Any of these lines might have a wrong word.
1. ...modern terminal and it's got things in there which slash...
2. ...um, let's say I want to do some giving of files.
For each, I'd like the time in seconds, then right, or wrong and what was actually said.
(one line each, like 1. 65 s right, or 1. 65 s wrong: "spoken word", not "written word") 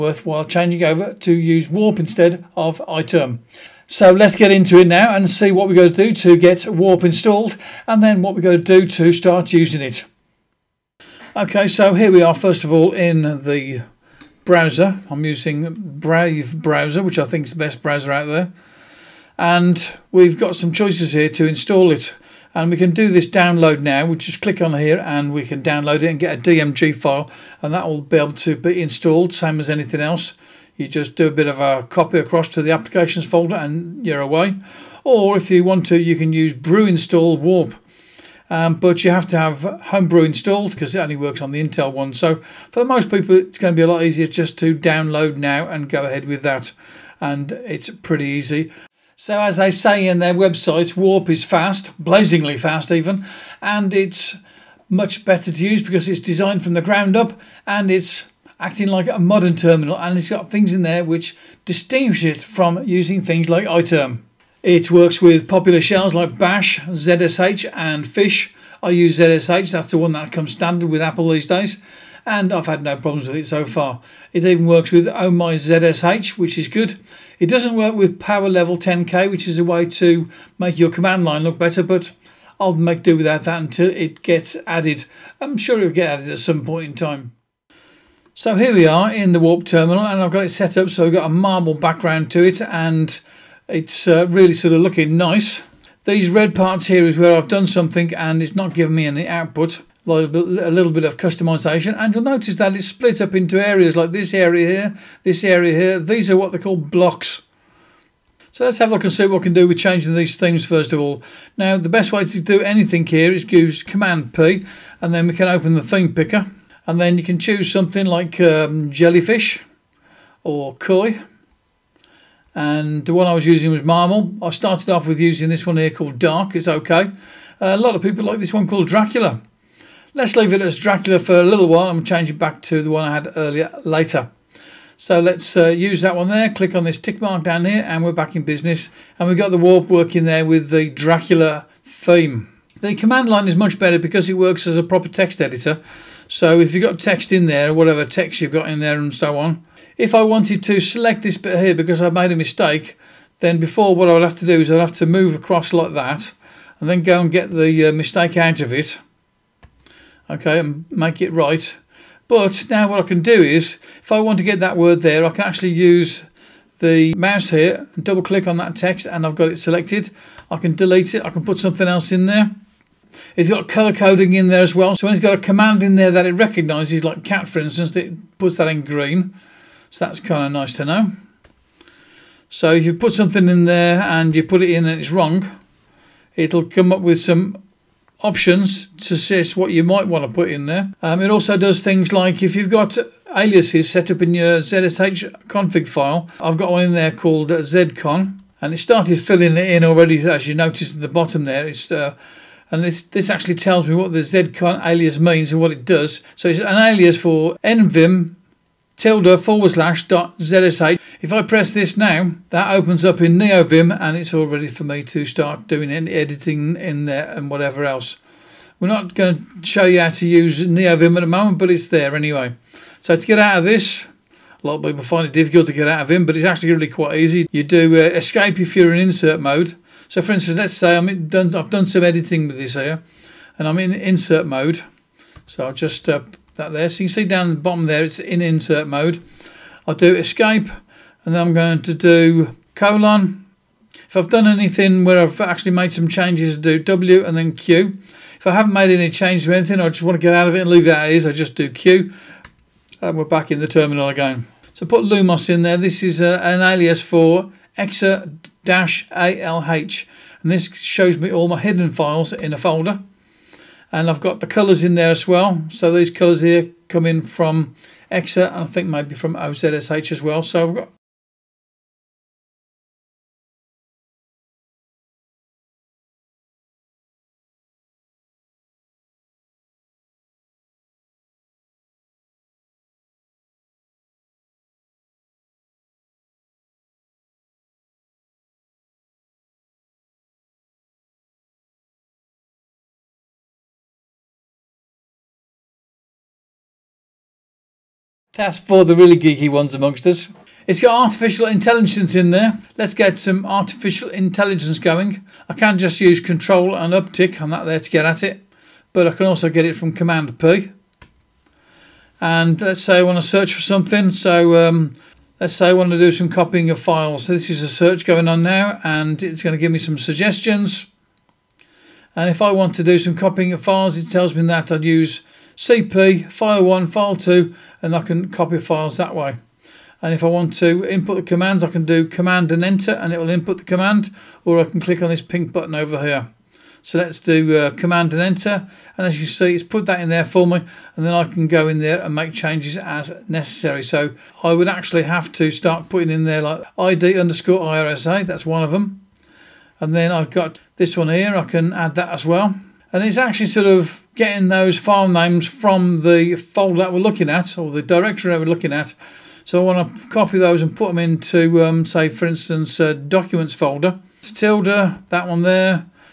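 1. 59 s wrong: "distinguish", not "slash"
2. 314 s wrong: "copying", not "giving".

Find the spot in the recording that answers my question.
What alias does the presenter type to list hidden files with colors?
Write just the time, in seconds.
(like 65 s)
255 s.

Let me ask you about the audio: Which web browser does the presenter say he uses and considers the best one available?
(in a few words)
Brave.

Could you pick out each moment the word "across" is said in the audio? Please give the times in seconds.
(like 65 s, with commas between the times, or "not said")
32 s, 155 s.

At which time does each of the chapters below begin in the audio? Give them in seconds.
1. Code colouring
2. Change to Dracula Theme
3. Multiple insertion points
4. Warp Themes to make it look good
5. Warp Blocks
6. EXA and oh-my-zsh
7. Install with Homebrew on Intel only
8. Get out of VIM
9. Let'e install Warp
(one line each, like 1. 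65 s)
1. 179 s
2. 127 s
3. 286 s
4. 87 s
5. 106 s
6. 265 s
7. 39 s
8. 227 s
9. 10 s.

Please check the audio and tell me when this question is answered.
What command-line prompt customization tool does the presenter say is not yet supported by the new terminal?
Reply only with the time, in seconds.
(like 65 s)
78 s.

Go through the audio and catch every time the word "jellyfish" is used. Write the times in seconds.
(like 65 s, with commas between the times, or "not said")
118 s.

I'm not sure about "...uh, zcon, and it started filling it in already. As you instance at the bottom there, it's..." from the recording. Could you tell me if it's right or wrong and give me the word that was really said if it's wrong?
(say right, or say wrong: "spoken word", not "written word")
wrong: "notice", not "instance".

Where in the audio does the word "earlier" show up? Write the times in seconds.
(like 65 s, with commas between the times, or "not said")
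133 s.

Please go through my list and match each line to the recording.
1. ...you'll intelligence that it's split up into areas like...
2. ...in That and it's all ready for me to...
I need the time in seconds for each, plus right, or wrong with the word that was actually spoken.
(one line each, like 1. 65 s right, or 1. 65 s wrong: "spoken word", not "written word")
1. 102 s wrong: "notice", not "intelligence"
2. 213 s wrong: "NeoVim", not "That".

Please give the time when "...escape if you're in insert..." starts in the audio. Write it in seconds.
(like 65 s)
228 s.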